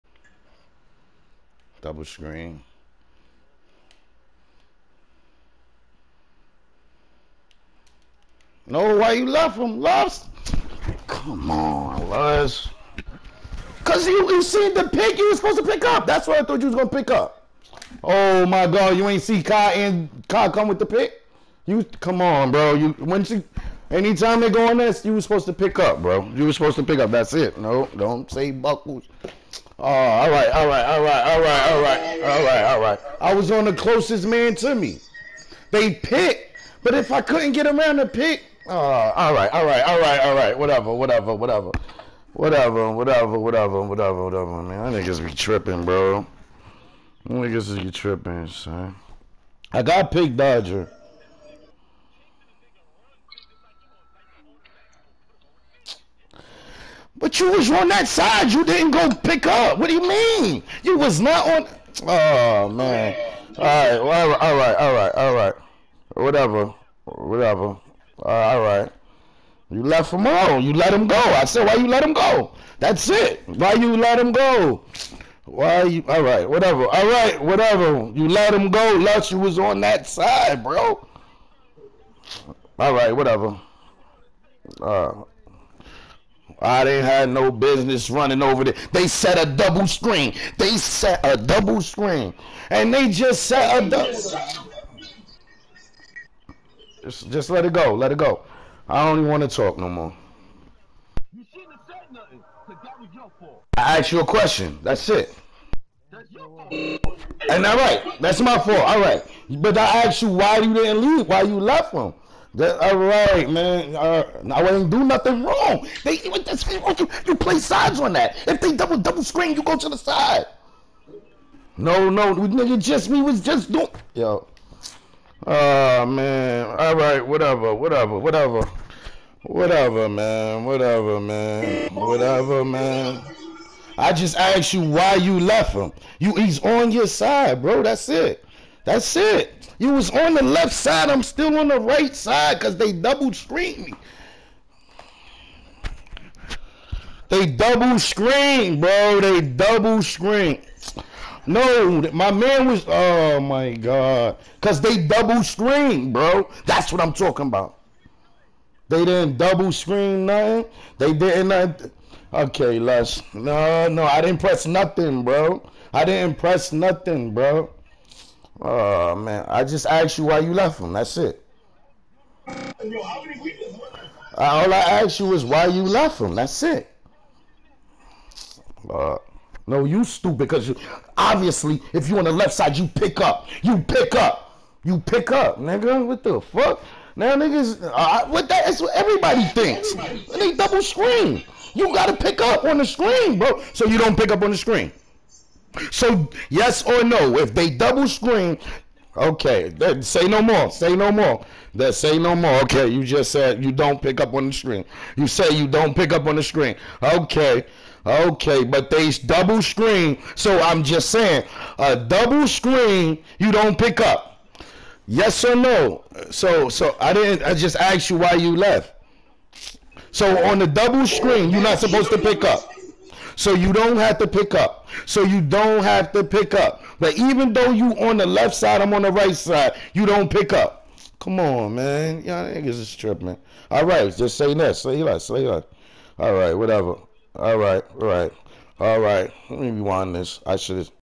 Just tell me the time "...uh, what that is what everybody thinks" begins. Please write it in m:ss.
3:07.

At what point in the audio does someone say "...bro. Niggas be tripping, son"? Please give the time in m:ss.
0:45.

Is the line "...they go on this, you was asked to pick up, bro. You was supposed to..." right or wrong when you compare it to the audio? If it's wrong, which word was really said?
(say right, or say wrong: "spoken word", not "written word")
wrong: "supposed", not "asked".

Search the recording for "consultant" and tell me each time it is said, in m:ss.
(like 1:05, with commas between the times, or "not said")
not said.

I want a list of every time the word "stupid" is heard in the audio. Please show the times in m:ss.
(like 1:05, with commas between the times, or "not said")
3:00.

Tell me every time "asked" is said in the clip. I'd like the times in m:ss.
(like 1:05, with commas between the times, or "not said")
1:43, 1:50, 2:14, 2:49, 2:54, 3:37.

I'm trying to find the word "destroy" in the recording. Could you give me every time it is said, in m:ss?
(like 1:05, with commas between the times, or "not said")
not said.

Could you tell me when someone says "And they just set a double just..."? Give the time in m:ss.
1:32.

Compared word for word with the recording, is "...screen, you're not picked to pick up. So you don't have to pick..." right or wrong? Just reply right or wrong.
wrong.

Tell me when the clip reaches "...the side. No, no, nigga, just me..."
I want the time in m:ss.
1:59.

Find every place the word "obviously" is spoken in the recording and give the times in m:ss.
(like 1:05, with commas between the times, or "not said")
3:01.